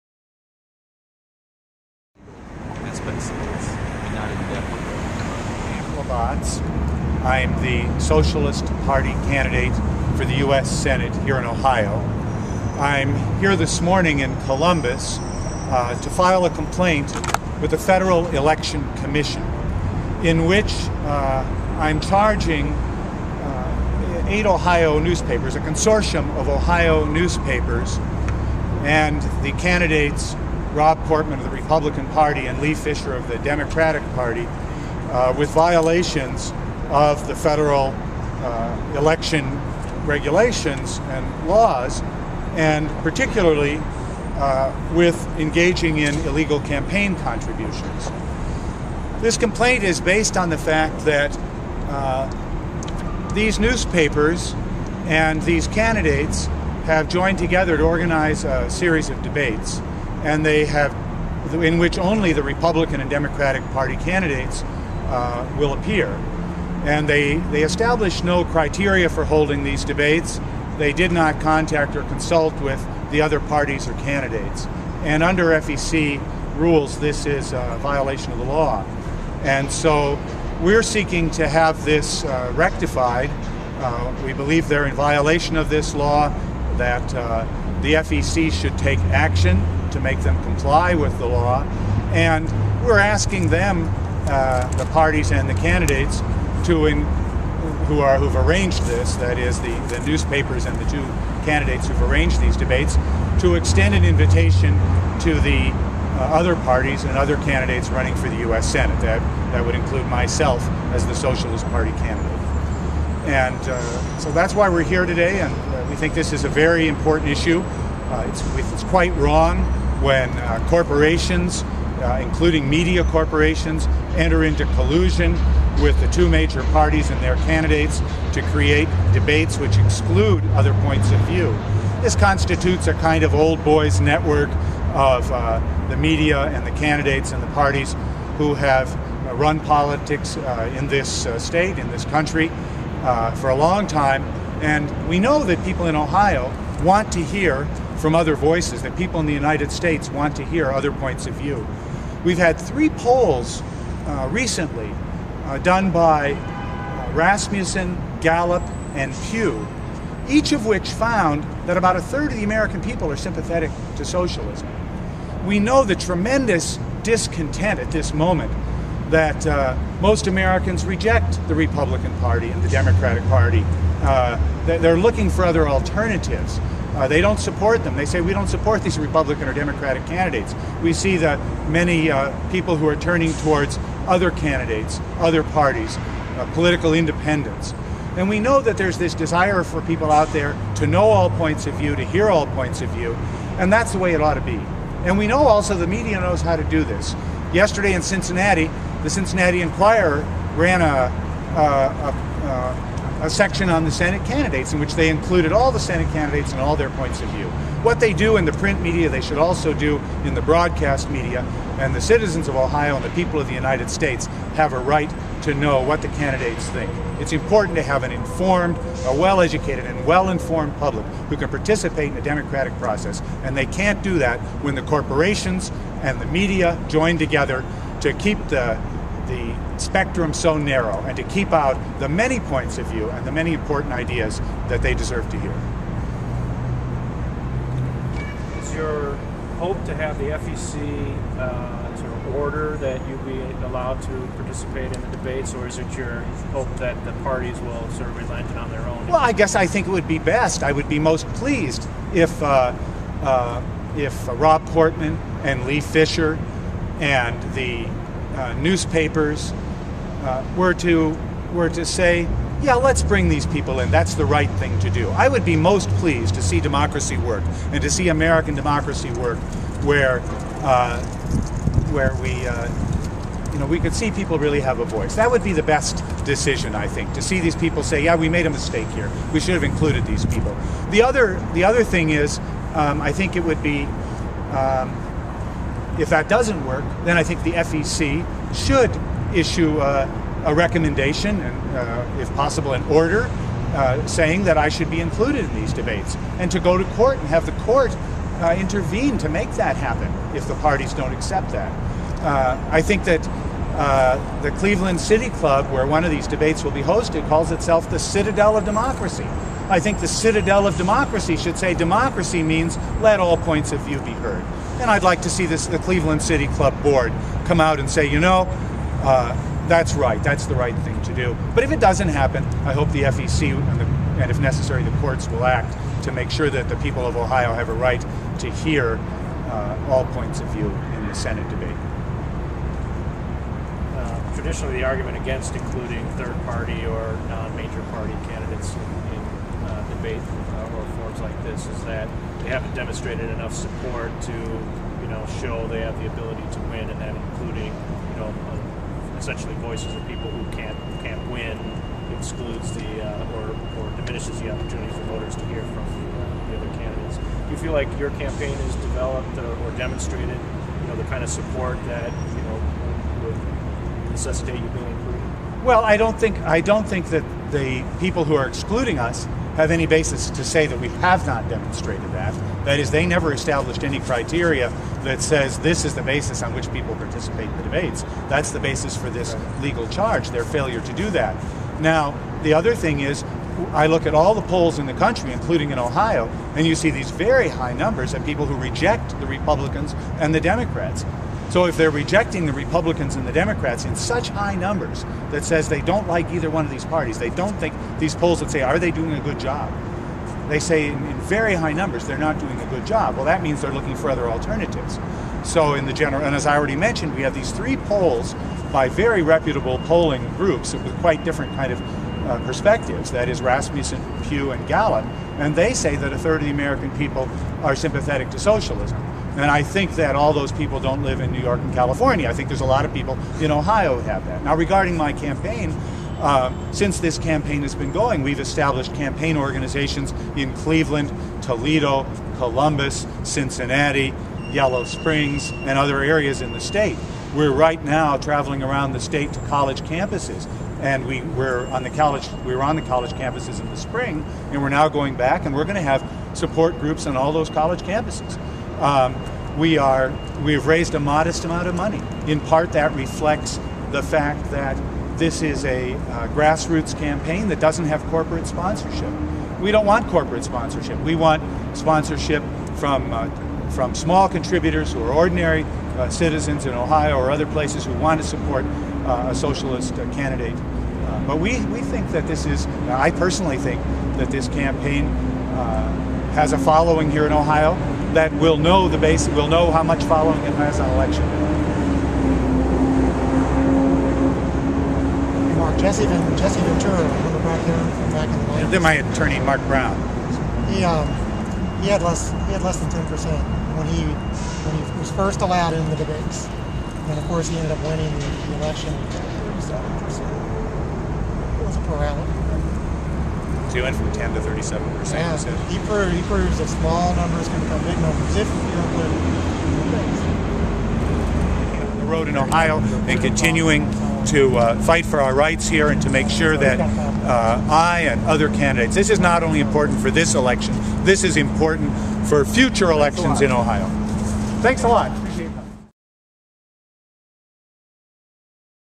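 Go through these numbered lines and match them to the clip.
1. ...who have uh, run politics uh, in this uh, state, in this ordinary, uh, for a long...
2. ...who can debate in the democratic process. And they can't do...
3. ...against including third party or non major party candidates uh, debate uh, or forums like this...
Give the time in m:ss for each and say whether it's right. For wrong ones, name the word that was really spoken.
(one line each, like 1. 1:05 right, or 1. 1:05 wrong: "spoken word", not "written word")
1. 2:18 wrong: "country", not "ordinary"
2. 3:41 wrong: "participate", not "debate"
3. 5:35 right.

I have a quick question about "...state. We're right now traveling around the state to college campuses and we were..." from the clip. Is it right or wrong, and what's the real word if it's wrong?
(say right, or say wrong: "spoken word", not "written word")
right.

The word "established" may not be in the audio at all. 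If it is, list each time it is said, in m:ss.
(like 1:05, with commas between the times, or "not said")
1:07, 6:13, 7:08.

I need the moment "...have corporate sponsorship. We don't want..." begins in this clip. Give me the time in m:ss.
7:37.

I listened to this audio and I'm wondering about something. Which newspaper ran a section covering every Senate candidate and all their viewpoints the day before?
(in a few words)
Cincinnati Enquirer.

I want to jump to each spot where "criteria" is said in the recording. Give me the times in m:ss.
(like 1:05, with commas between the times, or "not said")
1:08, 6:13.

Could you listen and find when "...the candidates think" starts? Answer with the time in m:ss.
3:36.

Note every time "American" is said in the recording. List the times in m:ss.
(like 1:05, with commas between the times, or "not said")
2:42, 2:50, 4:28, 6:56.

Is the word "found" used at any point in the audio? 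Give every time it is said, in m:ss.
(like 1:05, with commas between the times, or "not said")
2:40.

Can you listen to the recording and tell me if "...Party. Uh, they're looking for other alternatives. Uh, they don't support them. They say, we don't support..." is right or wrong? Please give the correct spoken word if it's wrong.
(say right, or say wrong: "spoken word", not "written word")
right.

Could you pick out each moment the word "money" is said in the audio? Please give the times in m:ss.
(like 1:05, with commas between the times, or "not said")
7:31.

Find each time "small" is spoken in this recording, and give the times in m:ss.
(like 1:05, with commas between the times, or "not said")
7:43, 8:26.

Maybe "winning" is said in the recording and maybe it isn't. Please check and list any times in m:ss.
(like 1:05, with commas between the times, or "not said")
8:17.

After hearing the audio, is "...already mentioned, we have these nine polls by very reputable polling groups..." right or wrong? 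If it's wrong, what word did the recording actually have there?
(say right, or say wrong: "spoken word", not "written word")
wrong: "three", not "nine".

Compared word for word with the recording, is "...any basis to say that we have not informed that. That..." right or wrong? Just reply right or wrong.
wrong.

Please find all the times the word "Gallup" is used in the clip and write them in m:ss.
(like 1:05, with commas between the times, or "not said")
2:38, 6:54.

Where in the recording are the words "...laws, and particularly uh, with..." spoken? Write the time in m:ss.
0:41.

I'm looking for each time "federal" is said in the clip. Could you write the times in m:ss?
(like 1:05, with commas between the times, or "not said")
0:17, 0:37.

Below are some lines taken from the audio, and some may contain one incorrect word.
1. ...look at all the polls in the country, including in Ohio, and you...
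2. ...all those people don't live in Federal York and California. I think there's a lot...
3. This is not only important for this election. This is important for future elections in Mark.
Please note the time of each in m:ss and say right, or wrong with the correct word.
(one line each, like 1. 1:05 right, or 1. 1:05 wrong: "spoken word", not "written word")
1. 6:23 right
2. 7:00 wrong: "New", not "Federal"
3. 8:38 wrong: "Ohio", not "Mark".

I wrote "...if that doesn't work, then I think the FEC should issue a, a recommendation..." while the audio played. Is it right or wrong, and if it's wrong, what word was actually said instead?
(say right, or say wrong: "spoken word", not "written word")
right.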